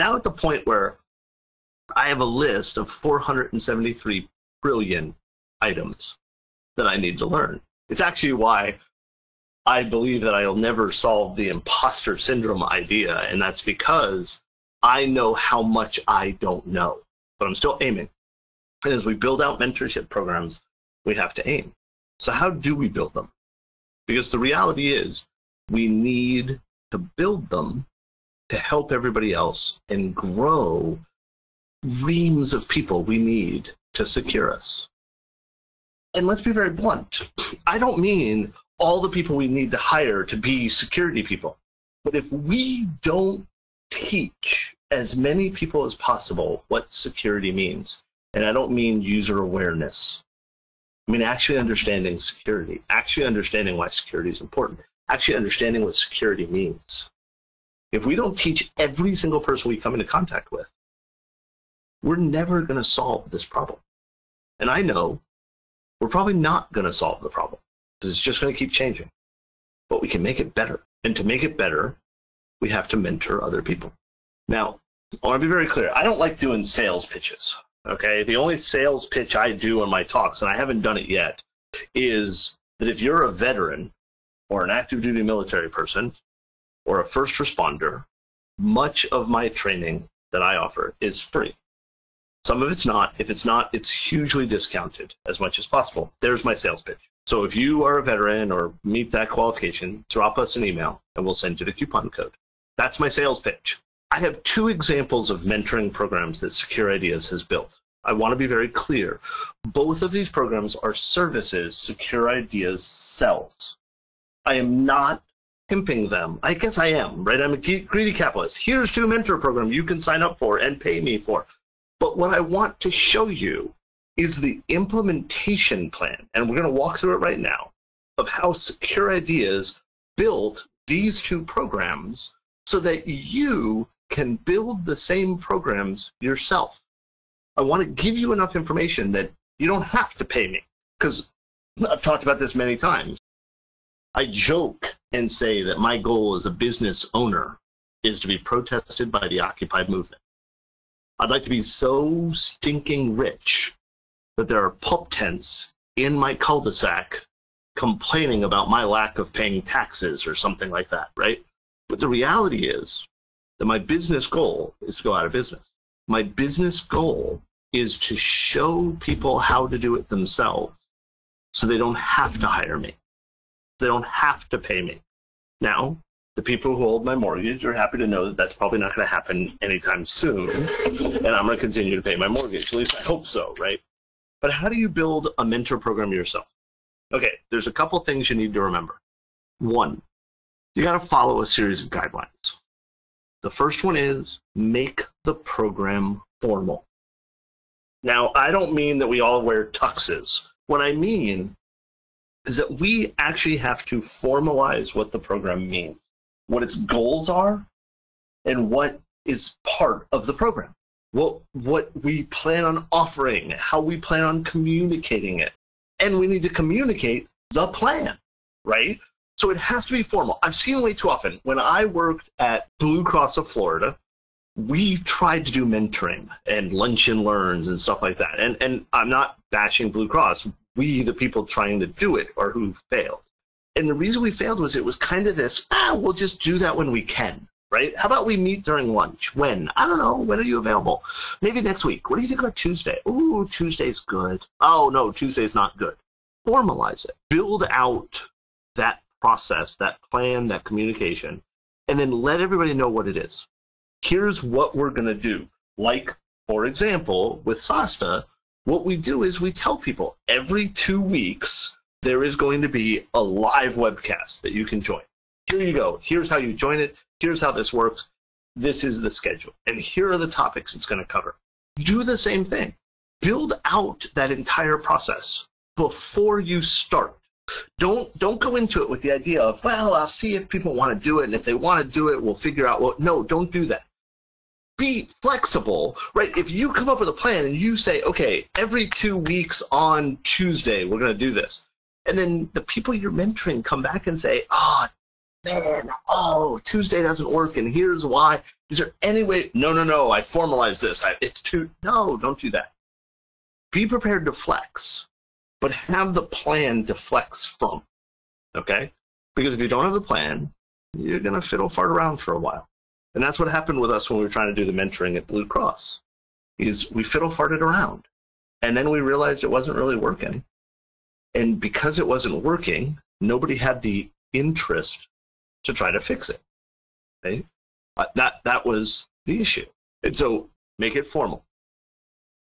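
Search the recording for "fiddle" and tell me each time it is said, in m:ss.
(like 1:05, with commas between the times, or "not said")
5:11, 5:17.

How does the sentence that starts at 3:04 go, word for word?
But how do you build a mentor program yourself?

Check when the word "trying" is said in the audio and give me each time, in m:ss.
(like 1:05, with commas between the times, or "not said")
3:51, 5:14.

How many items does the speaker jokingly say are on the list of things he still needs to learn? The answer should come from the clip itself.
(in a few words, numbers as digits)
473 trillion.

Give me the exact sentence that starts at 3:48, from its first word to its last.
And and I'm not bashing Blue Cross.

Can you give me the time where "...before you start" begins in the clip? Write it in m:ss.
4:35.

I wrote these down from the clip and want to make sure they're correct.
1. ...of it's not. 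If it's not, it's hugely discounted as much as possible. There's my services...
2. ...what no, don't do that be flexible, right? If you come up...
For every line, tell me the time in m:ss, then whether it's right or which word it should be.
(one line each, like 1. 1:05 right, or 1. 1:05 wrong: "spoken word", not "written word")
1. 1:32 wrong: "sales", not "services"
2. 4:42 right.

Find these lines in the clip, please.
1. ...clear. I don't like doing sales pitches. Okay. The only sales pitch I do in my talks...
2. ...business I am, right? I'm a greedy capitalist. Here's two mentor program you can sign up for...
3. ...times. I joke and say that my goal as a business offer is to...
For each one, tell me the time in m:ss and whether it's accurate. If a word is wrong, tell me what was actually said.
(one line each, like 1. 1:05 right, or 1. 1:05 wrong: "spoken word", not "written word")
1. 1:15 right
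2. 1:56 wrong: "guess", not "business"
3. 2:22 wrong: "owner", not "offer".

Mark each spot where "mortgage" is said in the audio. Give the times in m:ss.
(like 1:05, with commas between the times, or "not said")
2:57, 3:02.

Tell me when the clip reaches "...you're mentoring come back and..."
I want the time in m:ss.
4:52.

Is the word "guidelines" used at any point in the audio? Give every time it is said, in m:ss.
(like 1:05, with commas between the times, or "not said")
3:11.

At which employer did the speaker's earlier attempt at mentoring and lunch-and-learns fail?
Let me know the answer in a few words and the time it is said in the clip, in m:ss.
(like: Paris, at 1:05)
Blue Cross of Florida, at 3:42.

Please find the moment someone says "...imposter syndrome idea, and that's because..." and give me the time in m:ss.
0:11.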